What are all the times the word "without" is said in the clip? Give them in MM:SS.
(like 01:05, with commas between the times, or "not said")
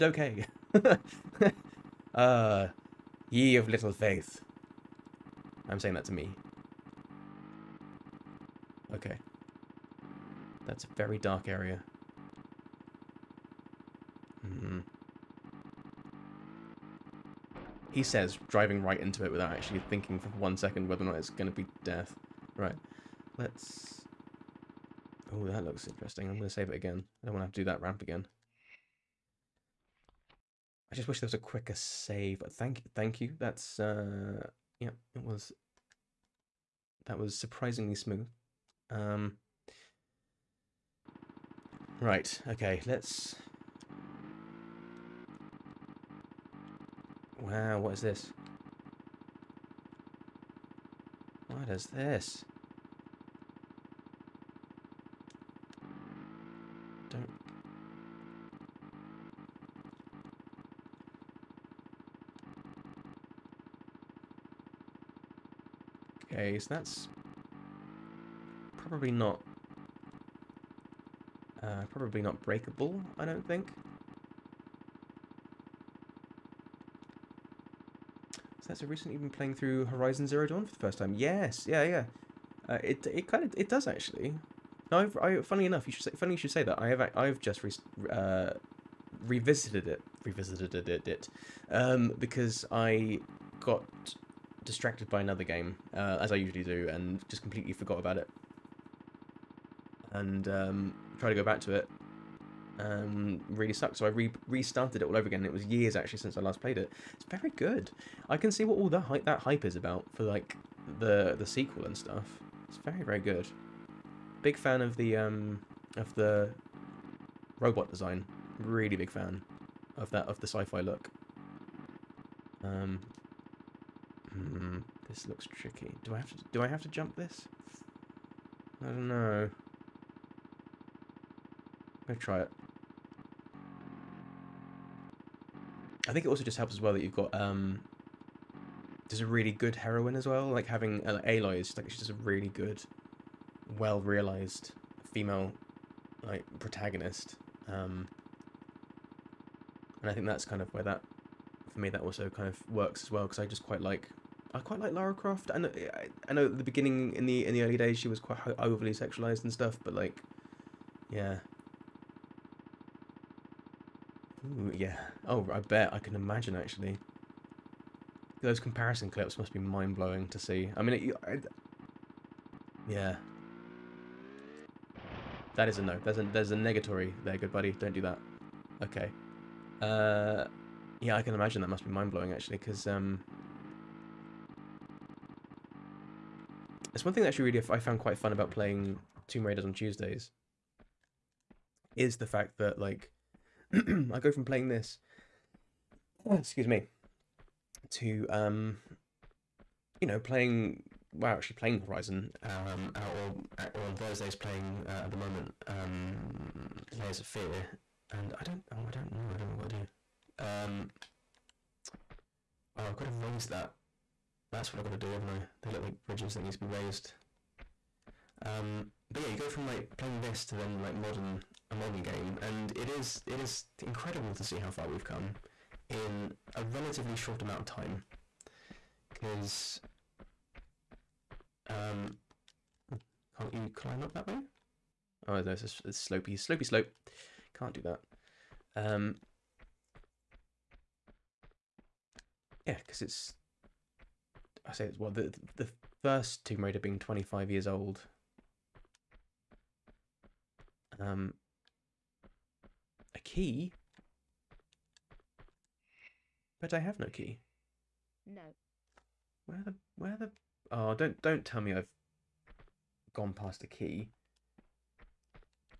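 00:19.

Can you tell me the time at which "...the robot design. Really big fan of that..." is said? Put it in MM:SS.
01:56.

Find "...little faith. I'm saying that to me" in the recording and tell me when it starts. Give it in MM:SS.
00:03.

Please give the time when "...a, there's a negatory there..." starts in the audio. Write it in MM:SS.
02:56.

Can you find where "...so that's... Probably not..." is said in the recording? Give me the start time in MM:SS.
01:06.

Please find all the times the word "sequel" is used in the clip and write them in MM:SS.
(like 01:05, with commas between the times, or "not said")
01:51.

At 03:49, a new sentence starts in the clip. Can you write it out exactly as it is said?
Because um, can't you climb up that way?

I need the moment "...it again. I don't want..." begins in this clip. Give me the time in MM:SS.
00:26.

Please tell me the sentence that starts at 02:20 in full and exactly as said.
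Like having uh, Aloy is just, like she's just a really good, well realized female like protagonist.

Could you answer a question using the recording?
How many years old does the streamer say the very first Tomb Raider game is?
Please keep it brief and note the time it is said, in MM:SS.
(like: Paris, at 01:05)
25, at 04:06.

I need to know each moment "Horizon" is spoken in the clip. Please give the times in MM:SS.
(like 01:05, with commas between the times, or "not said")
01:19, 03:21.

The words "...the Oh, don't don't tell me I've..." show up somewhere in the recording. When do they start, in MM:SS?
04:20.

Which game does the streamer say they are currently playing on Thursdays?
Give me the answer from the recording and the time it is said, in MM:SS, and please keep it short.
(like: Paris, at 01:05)
Layers of Fear, at 03:26.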